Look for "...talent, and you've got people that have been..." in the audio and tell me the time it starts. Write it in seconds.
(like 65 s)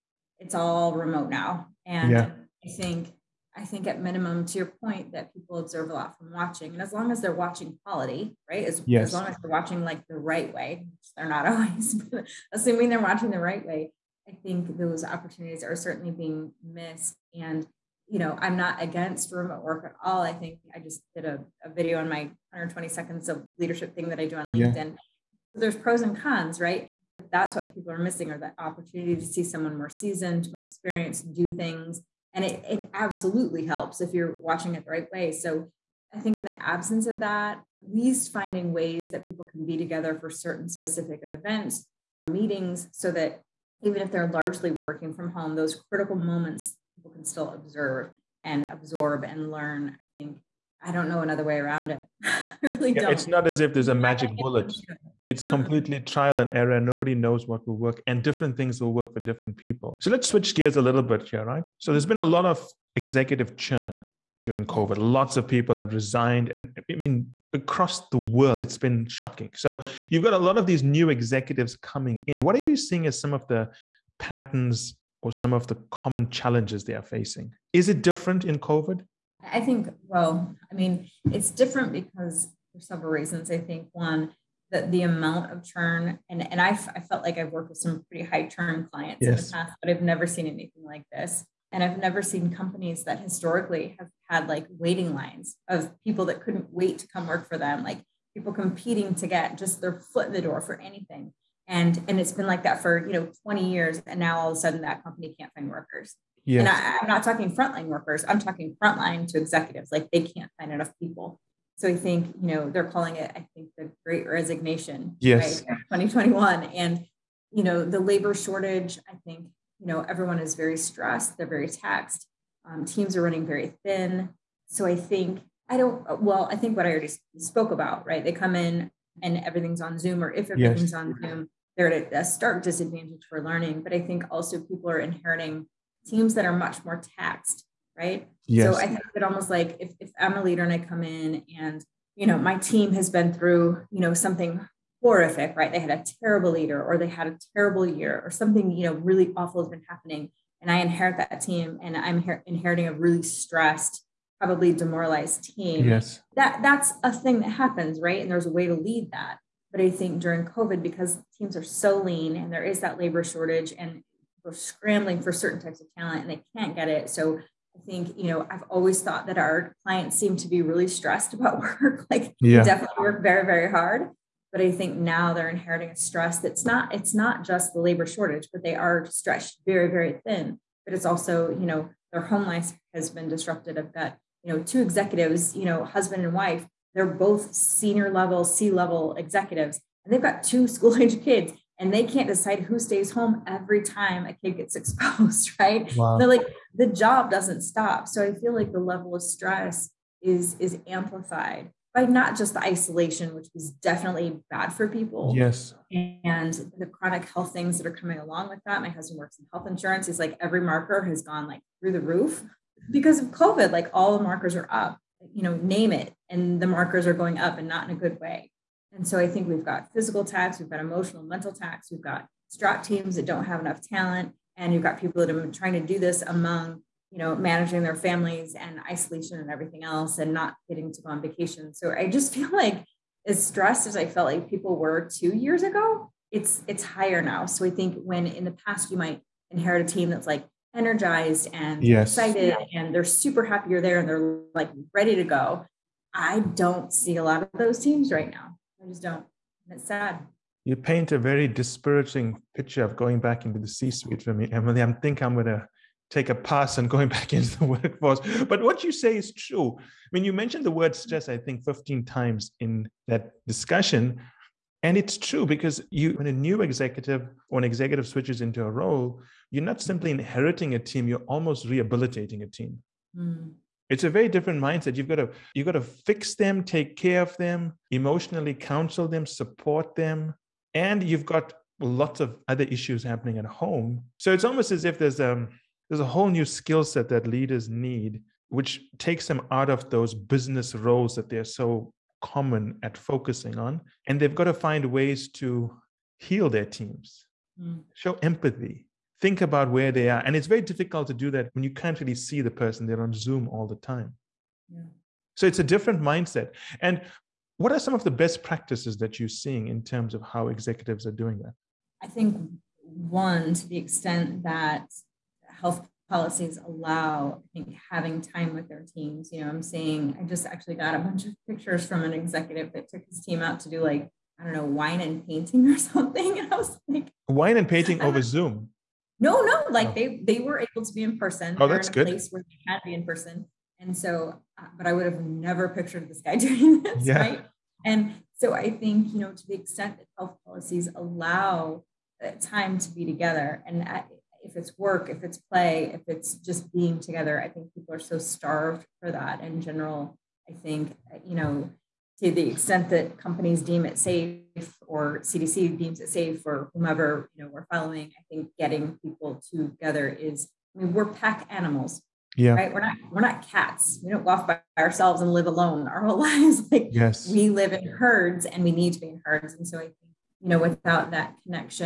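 223 s.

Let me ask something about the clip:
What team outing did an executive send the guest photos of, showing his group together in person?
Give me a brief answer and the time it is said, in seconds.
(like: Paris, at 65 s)
wine and painting, at 324 s.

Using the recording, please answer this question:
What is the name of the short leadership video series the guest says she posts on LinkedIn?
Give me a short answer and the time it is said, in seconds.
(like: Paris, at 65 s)
120 seconds of leadership, at 22 s.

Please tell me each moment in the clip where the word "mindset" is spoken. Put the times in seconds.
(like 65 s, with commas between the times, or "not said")
274 s, 306 s.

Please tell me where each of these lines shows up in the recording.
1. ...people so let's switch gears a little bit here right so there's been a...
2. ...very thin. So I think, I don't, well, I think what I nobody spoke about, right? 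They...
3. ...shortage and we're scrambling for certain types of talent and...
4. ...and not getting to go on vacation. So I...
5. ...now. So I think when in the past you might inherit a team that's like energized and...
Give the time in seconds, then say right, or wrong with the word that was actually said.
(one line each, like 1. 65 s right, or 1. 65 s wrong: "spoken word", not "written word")
1. 59 s right
2. 123 s wrong: "already", not "nobody"
3. 163 s right
4. 230 s right
5. 237 s right.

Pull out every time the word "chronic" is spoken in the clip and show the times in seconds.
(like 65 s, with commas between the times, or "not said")
206 s.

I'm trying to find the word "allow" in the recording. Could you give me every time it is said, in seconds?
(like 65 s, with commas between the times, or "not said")
316 s, 340 s.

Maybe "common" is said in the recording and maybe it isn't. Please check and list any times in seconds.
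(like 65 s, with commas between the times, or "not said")
75 s, 292 s.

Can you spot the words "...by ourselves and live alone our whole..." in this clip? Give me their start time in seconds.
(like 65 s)
364 s.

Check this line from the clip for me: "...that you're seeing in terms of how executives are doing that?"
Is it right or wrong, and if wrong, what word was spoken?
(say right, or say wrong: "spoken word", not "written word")
right.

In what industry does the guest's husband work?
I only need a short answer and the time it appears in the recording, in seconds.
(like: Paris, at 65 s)
health insurance, at 209 s.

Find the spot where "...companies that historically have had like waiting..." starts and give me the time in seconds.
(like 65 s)
92 s.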